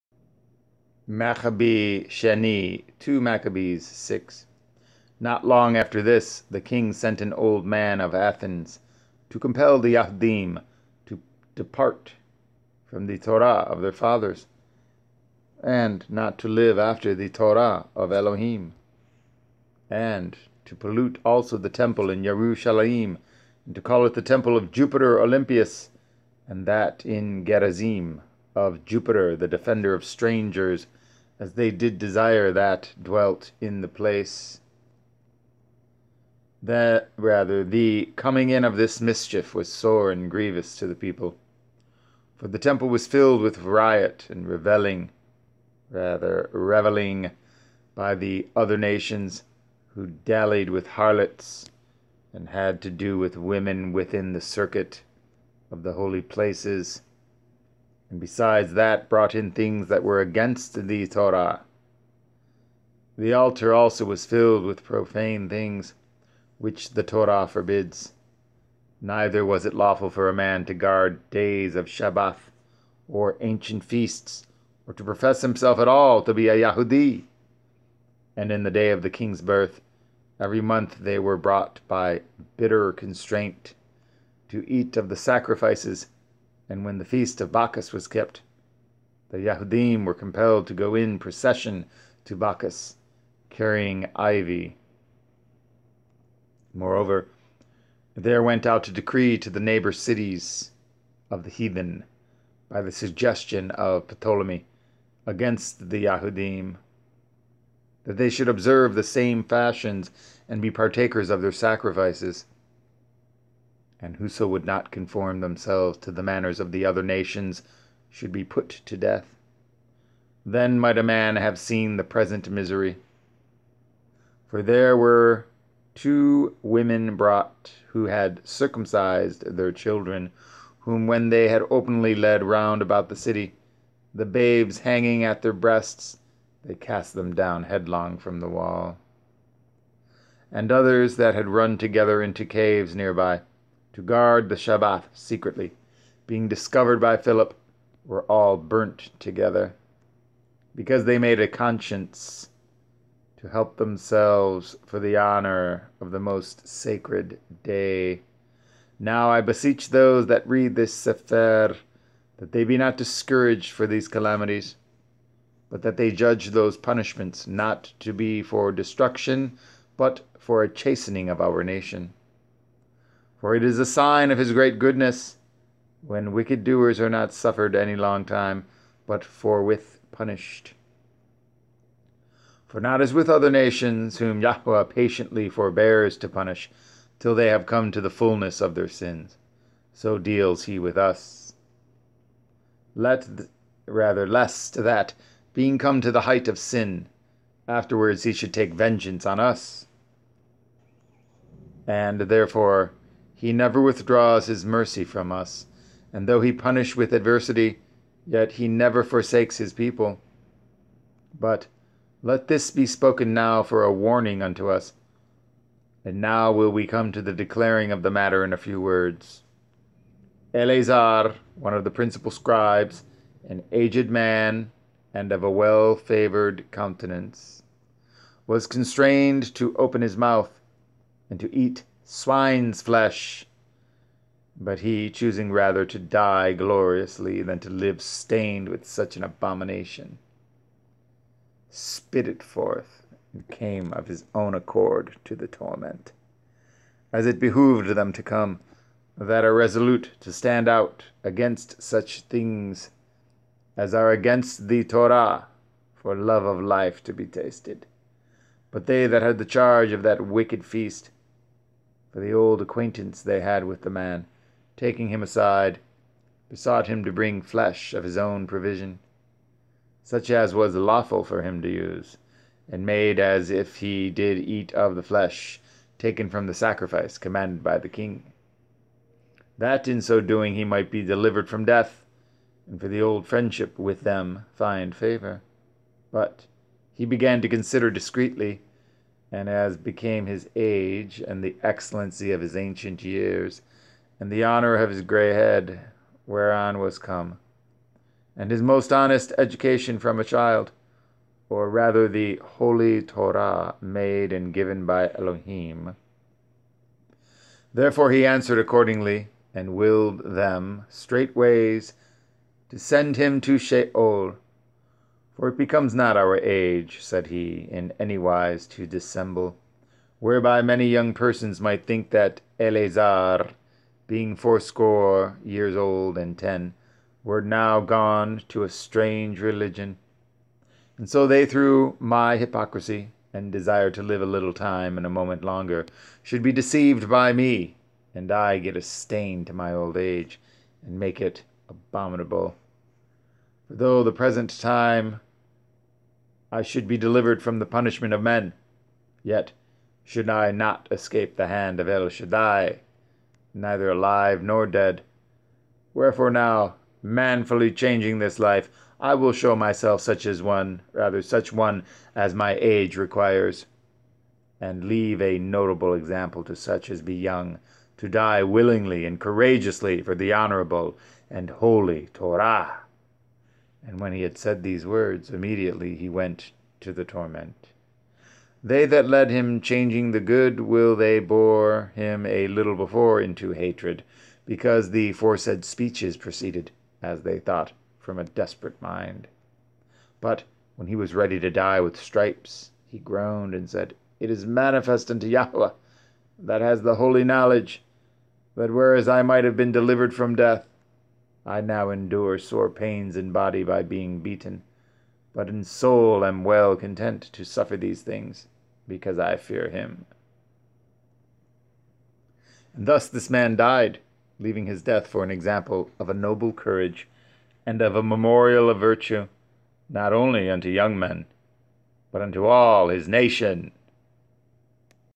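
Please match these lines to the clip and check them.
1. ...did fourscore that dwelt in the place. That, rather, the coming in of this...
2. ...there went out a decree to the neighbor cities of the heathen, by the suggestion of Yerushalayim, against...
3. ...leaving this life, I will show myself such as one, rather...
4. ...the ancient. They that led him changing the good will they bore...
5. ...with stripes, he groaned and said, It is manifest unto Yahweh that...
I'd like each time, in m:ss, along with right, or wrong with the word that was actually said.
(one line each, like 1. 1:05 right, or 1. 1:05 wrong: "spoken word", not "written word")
1. 0:31 wrong: "desire", not "fourscore"
2. 1:38 wrong: "Ptolemy", not "Yerushalayim"
3. 5:57 wrong: "changing", not "leaving"
4. 6:16 wrong: "torment", not "ancient"
5. 6:31 right.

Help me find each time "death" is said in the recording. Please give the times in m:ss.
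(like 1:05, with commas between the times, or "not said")
1:58, 4:41, 6:40, 6:54.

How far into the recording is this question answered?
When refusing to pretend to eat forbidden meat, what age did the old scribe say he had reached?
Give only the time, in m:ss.
5:24.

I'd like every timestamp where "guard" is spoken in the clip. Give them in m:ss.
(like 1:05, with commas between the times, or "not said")
1:10, 2:24.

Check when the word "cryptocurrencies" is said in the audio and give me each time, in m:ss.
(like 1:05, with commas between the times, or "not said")
not said.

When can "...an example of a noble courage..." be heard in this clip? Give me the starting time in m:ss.
6:55.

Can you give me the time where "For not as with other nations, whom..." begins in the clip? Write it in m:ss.
3:02.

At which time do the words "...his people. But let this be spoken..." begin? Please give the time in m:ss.
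3:29.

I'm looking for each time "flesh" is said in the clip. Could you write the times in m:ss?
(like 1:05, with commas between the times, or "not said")
3:52, 4:27, 4:35.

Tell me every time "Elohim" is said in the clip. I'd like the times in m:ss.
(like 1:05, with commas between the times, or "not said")
0:18, 5:05.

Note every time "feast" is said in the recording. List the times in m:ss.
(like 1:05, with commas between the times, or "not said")
1:13, 1:27, 4:20.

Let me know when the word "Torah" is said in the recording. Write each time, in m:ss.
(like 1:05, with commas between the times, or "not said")
0:13, 0:17, 1:01, 1:07, 4:14, 5:03, 6:12.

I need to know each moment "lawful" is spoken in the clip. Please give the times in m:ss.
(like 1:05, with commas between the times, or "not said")
1:09, 4:30.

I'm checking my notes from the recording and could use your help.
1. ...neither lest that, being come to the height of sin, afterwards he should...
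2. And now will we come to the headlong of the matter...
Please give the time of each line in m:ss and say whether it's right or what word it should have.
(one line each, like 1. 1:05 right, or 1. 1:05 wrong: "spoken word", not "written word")
1. 3:13 wrong: "rather", not "neither"
2. 3:36 wrong: "declaring", not "headlong".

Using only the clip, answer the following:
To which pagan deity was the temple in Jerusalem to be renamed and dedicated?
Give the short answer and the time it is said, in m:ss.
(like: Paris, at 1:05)
Jupiter Olympius, at 0:24.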